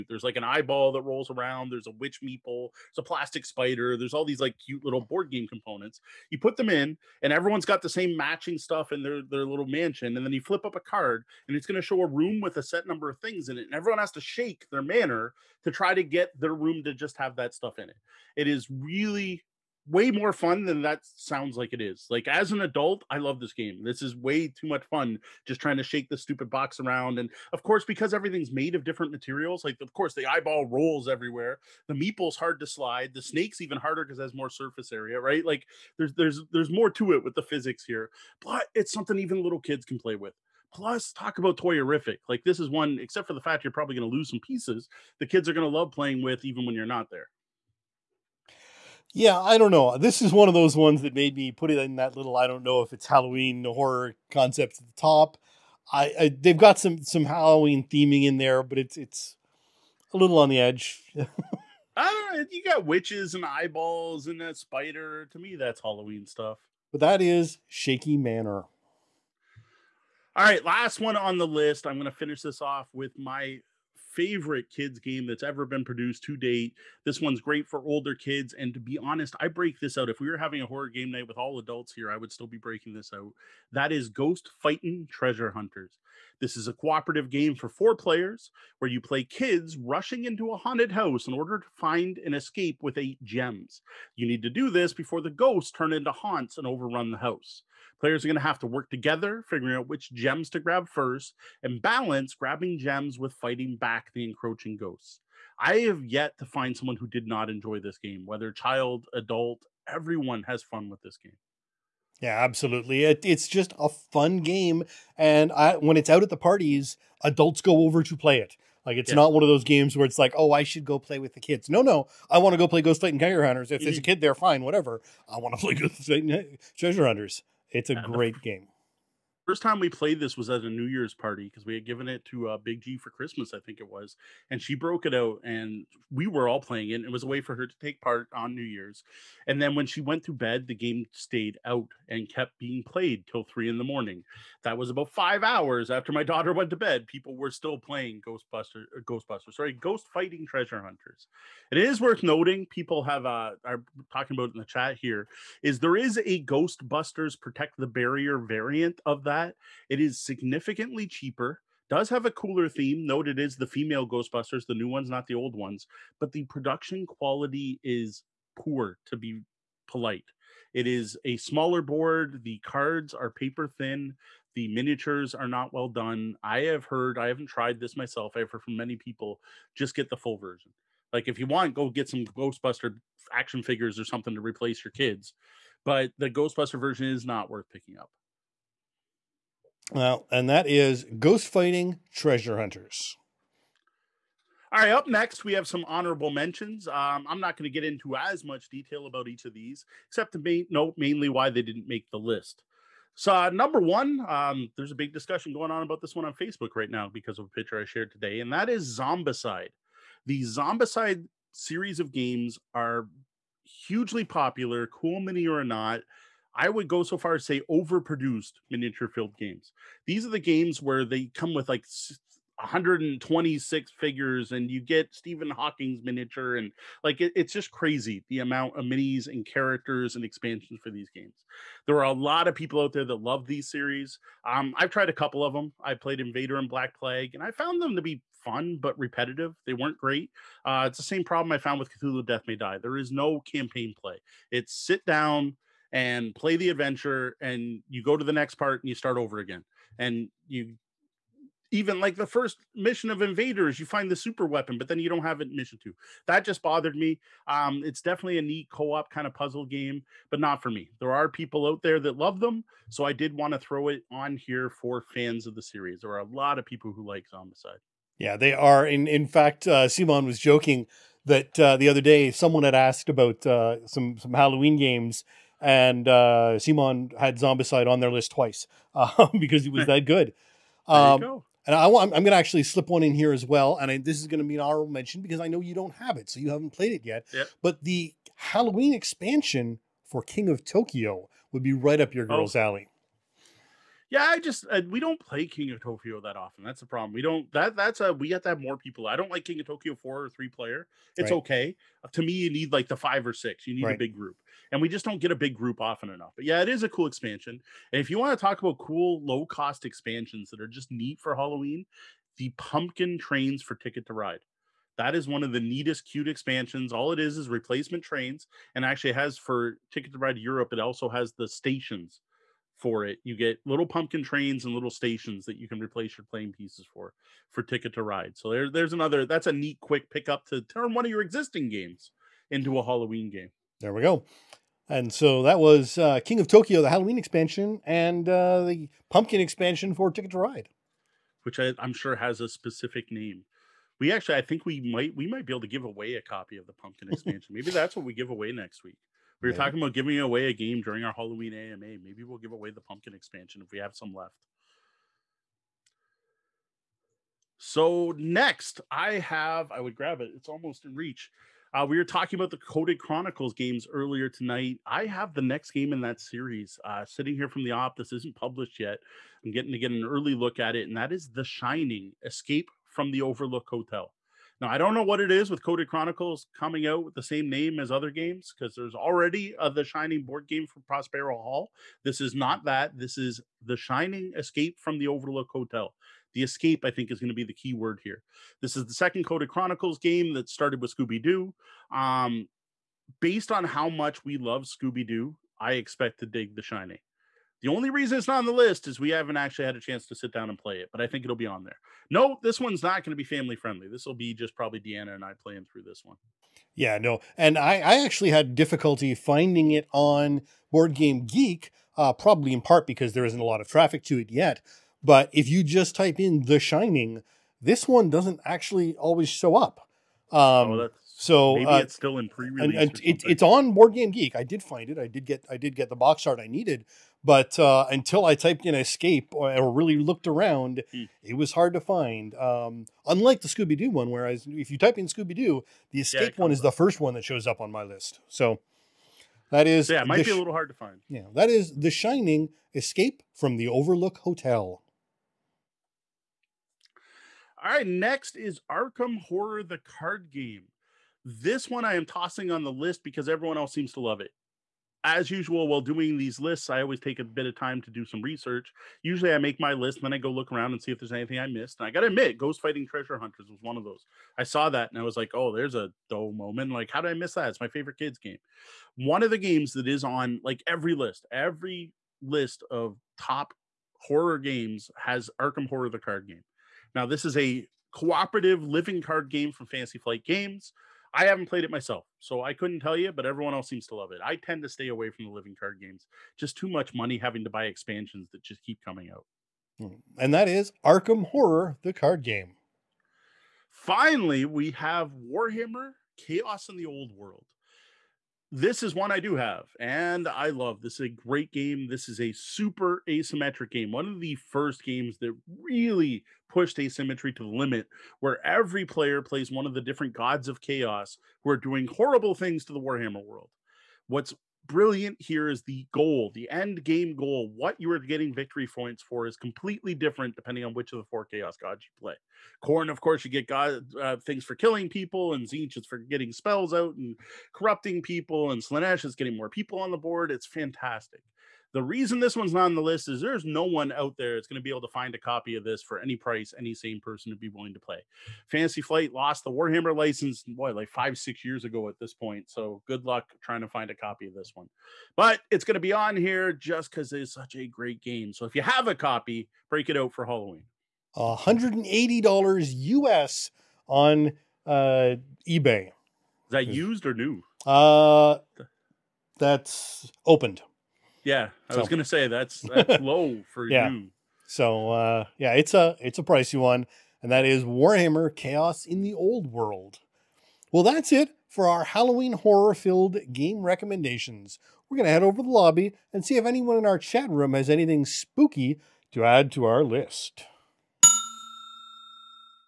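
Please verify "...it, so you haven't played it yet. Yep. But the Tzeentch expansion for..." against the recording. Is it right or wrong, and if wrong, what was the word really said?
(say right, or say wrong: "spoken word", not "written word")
wrong: "Halloween", not "Tzeentch".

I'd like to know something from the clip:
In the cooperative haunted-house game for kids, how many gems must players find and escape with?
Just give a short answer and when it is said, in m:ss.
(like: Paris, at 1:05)
8, at 1:32.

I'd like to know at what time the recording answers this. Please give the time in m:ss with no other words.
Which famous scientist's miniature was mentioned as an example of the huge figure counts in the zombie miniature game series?
3:45.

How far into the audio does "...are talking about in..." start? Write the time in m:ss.
2:33.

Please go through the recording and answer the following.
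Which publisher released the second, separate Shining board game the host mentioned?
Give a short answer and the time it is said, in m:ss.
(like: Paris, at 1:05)
Prospero Hall, at 6:20.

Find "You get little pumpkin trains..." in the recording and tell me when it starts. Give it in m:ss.
5:23.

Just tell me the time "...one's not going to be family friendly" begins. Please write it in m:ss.
6:42.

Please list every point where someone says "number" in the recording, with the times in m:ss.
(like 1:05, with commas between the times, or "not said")
0:12, 3:23.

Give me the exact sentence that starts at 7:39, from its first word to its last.
Usually, I make my list, and then I go look around and see if there's anything I missed.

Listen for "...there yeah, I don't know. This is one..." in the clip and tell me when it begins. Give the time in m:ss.
0:47.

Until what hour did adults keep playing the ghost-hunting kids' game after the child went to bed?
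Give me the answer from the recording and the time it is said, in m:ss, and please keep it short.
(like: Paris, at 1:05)
3 in the morning, at 2:23.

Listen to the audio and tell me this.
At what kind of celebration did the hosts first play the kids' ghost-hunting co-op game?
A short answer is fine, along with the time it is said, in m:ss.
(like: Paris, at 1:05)
New Year's party, at 2:10.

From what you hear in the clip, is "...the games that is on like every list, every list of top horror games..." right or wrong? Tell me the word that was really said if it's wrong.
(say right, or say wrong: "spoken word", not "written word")
right.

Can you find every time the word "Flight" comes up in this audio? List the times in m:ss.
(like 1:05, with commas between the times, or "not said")
7:59, 8:58.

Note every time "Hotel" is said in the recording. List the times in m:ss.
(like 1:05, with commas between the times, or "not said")
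6:13, 6:25, 7:24.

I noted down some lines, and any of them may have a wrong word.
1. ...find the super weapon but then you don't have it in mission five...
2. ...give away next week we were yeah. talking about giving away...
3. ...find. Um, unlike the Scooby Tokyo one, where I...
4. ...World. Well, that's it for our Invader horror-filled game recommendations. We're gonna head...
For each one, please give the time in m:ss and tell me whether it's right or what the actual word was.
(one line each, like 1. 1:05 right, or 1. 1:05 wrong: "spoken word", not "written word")
1. 4:13 wrong: "two", not "five"
2. 5:48 right
3. 7:11 wrong: "Doo", not "Tokyo"
4. 9:29 wrong: "Halloween", not "Invader".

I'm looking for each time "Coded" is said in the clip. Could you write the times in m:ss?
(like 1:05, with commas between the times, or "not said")
6:02, 6:15, 6:29.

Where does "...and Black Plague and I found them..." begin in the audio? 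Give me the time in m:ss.
3:56.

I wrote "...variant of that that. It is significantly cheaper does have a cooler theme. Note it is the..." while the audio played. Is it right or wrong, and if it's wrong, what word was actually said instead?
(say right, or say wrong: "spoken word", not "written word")
right.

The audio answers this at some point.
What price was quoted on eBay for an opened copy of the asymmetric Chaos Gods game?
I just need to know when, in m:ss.
9:11.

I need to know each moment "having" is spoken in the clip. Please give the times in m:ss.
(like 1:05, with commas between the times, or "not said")
1:20, 8:07.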